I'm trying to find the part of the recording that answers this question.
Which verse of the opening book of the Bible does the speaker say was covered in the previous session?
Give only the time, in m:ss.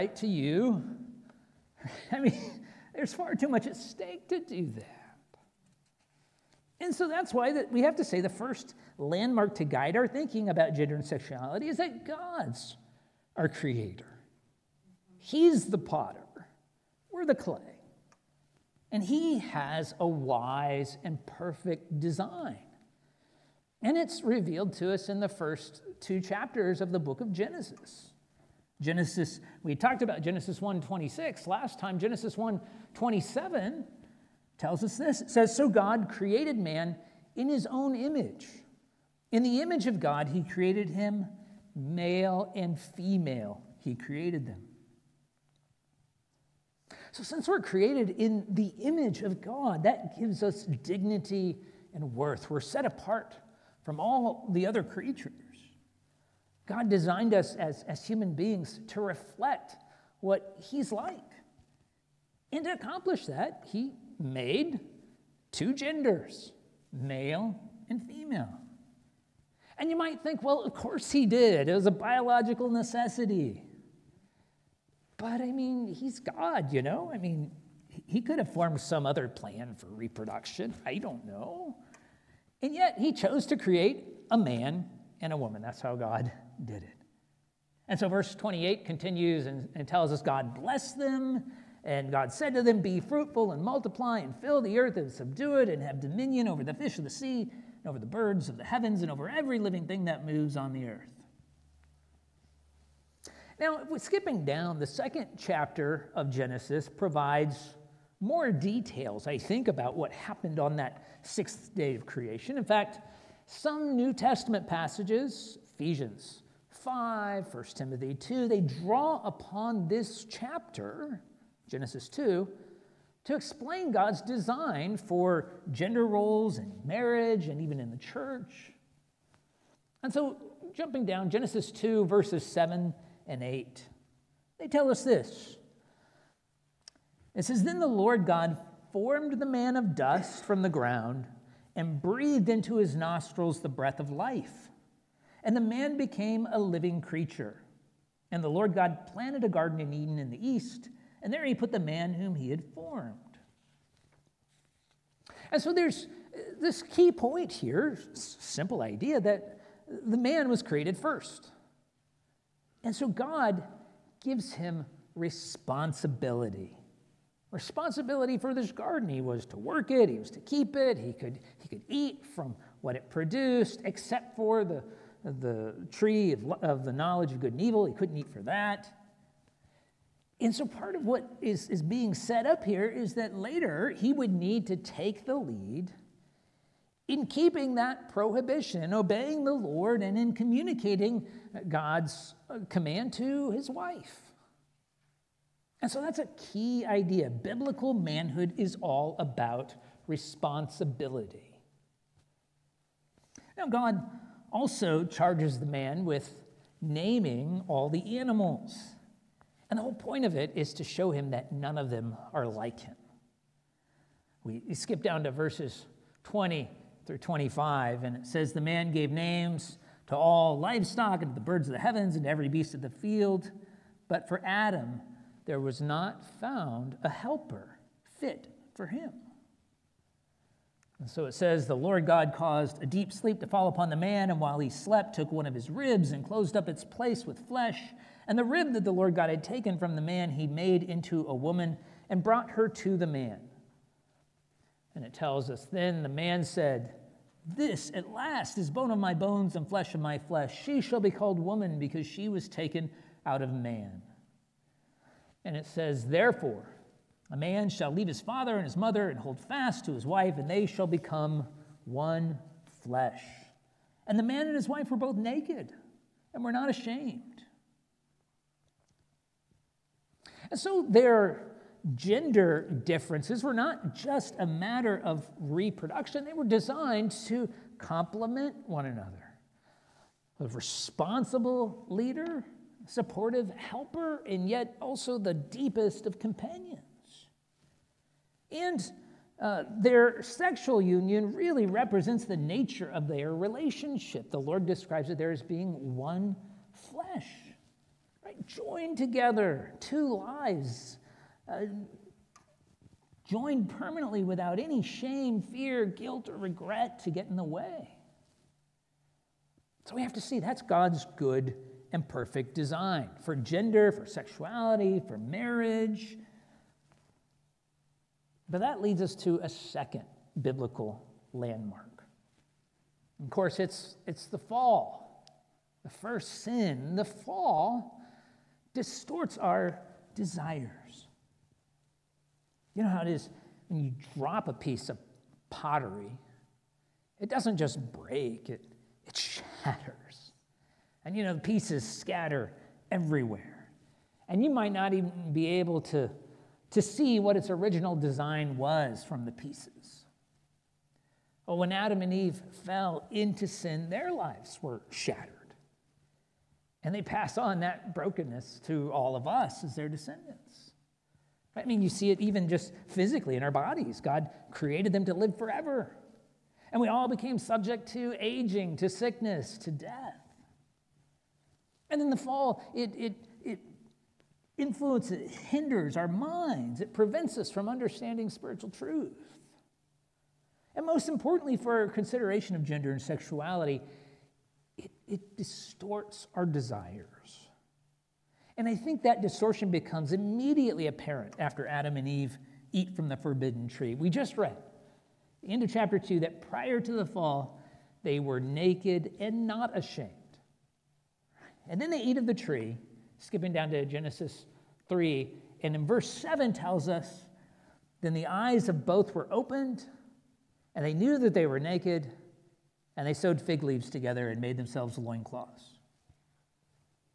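0:30.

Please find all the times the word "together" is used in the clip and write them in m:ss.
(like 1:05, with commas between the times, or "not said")
4:58, 6:53.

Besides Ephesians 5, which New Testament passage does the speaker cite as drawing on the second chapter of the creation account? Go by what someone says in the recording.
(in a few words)
1 Timothy 2.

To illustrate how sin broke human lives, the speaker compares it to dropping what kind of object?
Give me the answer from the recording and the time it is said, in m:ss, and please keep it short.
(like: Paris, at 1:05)
Pottery, at 5:34.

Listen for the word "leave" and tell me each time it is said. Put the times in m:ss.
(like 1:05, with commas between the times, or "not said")
4:17, 6:53.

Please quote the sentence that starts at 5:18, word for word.
But that leads us to a second biblical landmark.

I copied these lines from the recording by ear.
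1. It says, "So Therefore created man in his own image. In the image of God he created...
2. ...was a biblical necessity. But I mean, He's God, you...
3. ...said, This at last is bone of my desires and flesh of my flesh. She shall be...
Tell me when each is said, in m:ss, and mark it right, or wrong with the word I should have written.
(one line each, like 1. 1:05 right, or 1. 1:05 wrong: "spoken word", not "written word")
1. 0:35 wrong: "God", not "Therefore"
2. 1:11 wrong: "biological", not "biblical"
3. 4:06 wrong: "bones", not "desires".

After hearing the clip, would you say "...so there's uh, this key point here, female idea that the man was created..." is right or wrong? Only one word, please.
wrong.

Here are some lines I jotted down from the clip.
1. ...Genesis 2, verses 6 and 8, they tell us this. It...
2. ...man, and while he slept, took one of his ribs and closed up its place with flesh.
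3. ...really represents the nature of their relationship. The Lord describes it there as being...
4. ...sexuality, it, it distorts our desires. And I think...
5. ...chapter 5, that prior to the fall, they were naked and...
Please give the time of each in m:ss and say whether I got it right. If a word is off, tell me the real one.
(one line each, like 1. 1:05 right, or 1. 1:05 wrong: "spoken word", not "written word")
1. 2:11 wrong: "7", not "6"
2. 3:53 right
3. 4:51 right
4. 6:22 right
5. 6:35 wrong: "2", not "5".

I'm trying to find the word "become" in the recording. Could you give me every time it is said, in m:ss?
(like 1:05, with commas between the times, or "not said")
4:20, 6:29.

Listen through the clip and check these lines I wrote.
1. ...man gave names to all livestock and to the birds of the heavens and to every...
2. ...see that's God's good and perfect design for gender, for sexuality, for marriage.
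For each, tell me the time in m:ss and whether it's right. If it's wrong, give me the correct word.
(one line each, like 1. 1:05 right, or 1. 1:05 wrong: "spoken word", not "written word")
1. 3:38 right
2. 5:10 right.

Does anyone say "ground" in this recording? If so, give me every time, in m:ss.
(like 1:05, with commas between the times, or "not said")
2:20.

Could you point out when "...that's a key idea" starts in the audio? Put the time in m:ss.
3:16.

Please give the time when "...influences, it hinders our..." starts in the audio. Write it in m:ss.
6:14.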